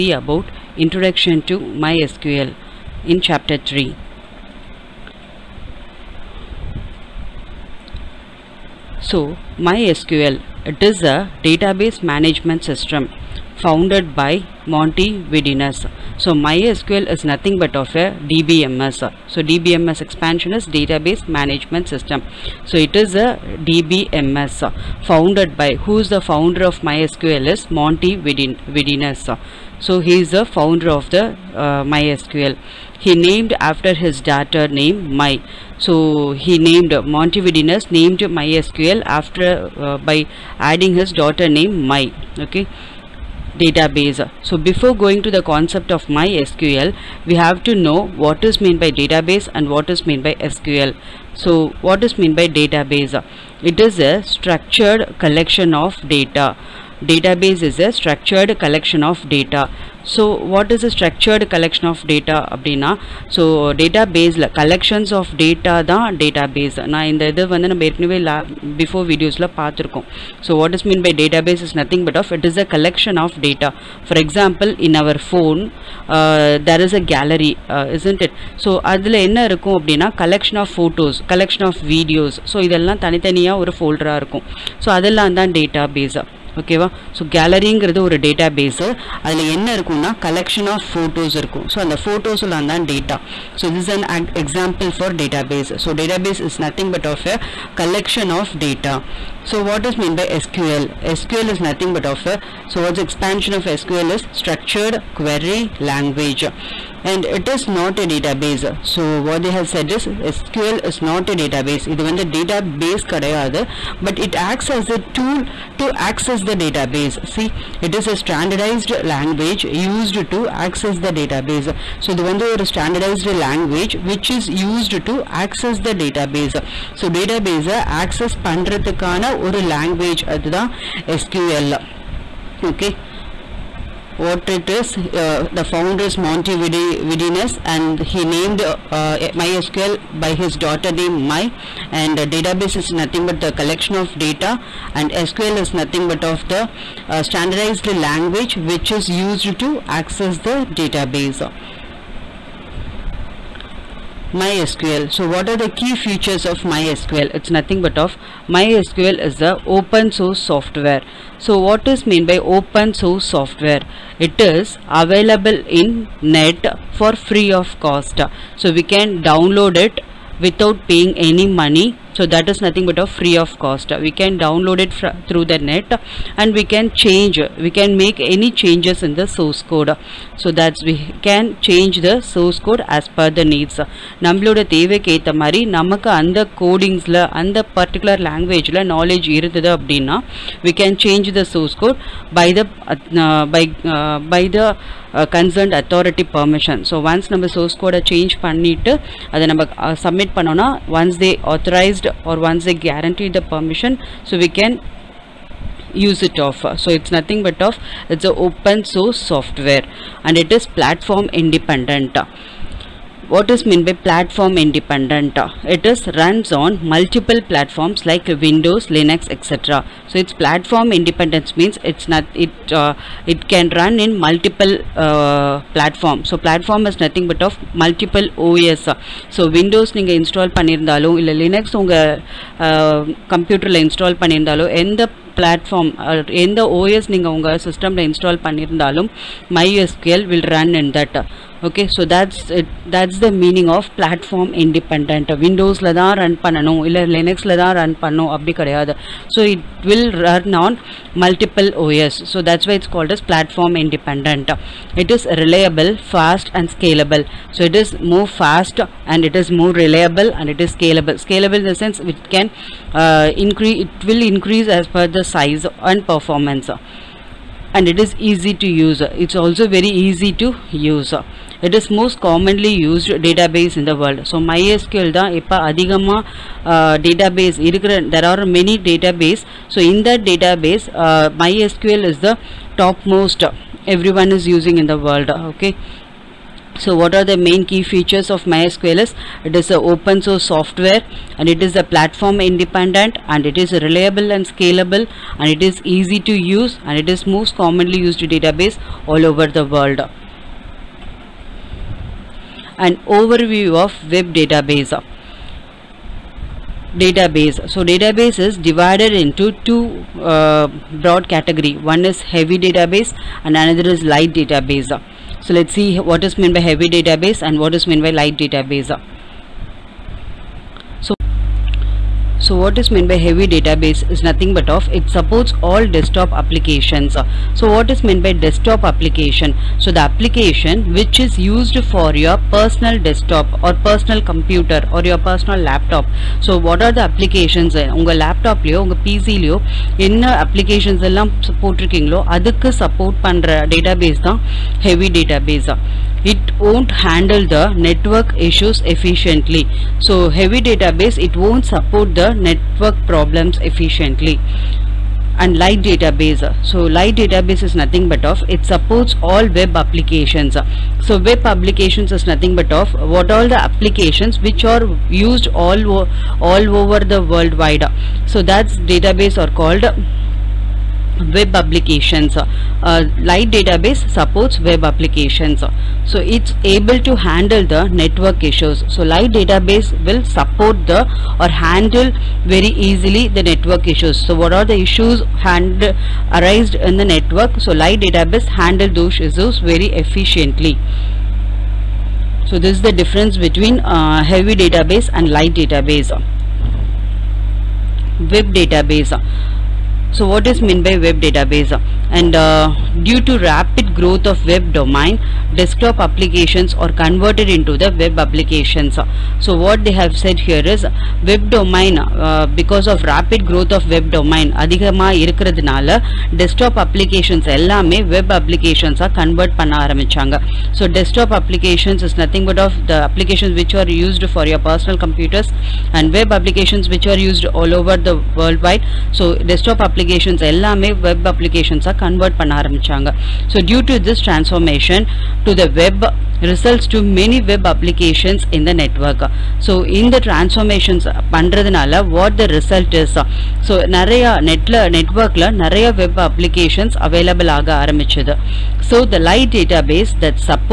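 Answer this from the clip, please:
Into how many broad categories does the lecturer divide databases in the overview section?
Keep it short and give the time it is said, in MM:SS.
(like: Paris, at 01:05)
2, at 05:09.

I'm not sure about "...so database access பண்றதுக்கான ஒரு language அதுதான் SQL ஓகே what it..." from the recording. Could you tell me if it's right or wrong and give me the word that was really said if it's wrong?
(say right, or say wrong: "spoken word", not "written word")
right.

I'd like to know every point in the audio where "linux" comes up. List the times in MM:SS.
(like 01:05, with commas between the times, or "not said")
03:38, 03:51, 04:07.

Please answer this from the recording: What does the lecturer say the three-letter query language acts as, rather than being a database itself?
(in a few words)
A tool.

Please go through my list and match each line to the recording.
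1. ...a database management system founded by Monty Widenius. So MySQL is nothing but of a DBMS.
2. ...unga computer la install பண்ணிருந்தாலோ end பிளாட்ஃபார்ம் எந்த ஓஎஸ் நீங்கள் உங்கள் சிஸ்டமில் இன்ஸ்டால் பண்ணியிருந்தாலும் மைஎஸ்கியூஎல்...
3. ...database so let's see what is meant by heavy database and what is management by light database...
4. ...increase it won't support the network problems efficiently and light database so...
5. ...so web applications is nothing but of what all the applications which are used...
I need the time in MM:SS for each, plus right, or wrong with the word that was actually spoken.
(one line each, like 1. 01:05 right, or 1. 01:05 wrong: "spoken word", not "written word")
1. 00:11 right
2. 03:51 right
3. 05:14 wrong: "meant", not "management"
4. 05:50 wrong: "database", not "increase"
5. 06:01 right.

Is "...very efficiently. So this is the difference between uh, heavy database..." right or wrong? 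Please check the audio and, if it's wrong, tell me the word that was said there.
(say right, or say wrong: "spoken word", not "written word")
right.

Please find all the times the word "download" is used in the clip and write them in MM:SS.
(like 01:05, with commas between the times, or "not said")
02:49, 02:54.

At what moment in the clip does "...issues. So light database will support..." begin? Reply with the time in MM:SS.
06:18.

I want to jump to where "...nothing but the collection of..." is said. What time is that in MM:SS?
02:22.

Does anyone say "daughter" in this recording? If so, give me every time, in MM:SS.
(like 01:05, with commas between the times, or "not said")
00:34, 00:41, 02:20.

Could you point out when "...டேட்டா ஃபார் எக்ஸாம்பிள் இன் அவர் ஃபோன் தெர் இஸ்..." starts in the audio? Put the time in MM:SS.
01:13.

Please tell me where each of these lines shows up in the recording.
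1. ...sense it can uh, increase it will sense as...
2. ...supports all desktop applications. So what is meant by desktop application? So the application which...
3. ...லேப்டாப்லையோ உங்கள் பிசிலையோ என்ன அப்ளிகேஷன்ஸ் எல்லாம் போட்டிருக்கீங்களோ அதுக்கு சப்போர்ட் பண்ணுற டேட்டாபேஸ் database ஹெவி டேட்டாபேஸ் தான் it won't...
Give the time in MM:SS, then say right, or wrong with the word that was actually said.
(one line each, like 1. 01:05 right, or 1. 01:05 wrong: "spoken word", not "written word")
1. 04:21 wrong: "increase", not "sense"
2. 05:25 right
3. 05:38 right.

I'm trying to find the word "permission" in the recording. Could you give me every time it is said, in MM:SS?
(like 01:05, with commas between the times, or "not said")
03:16, 03:23.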